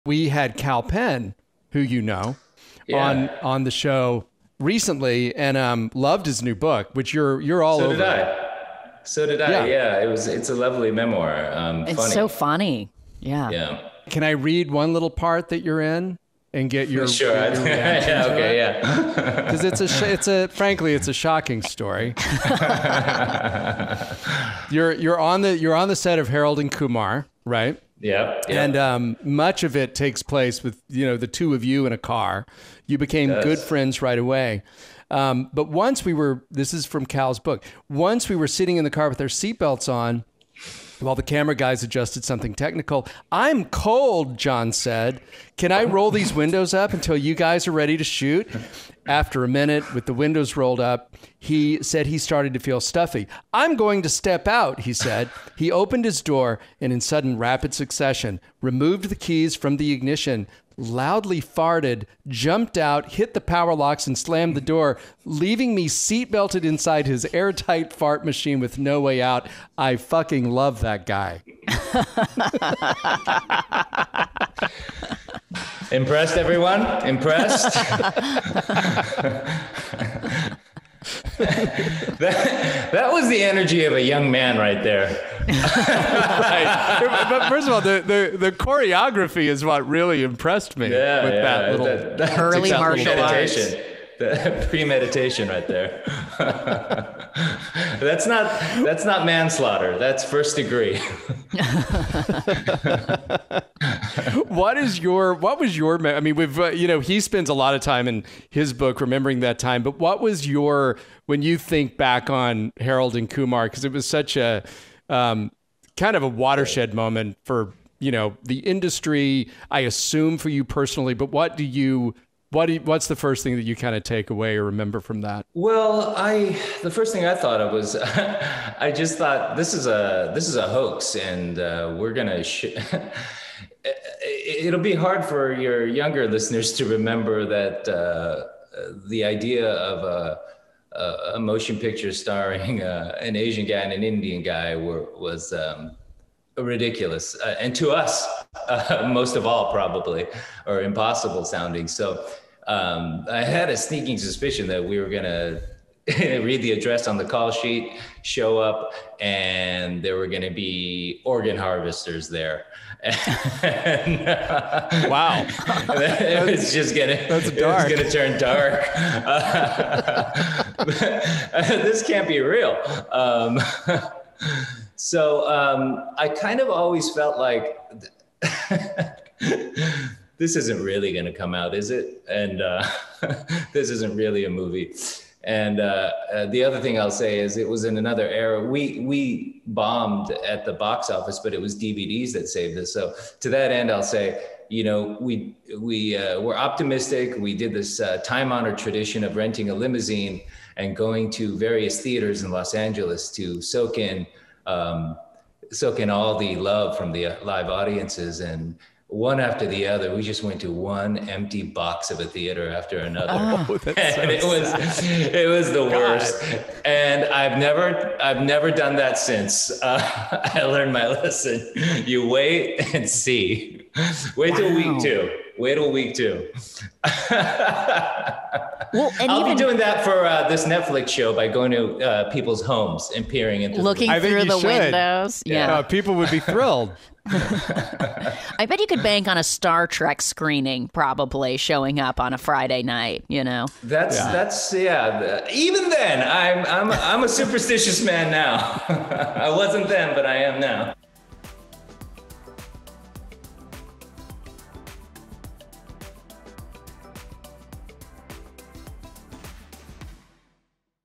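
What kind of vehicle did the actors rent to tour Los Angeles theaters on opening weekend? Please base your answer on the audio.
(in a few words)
Limousine.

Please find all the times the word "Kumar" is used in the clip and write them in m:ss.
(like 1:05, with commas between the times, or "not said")
0:26, 1:53.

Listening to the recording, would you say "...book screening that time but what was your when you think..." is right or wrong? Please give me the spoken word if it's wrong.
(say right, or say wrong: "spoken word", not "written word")
wrong: "remembering", not "screening".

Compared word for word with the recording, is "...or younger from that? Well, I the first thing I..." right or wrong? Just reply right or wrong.
wrong.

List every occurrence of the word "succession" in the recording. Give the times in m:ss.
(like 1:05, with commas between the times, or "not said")
0:57.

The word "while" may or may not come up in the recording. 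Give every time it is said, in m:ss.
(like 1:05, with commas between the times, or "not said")
0:41.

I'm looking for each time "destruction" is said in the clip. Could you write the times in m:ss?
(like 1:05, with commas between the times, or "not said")
not said.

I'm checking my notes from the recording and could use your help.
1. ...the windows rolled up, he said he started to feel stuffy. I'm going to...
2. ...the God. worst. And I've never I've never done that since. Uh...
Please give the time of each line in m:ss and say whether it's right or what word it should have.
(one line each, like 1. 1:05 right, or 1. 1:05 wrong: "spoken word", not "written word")
1. 0:50 right
2. 3:35 right.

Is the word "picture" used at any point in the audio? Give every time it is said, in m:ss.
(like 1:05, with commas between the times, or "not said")
2:21.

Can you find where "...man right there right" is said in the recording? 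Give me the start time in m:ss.
1:24.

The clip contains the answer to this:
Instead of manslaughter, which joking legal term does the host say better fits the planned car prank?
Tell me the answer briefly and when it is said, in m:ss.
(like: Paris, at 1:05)
First degree, at 1:40.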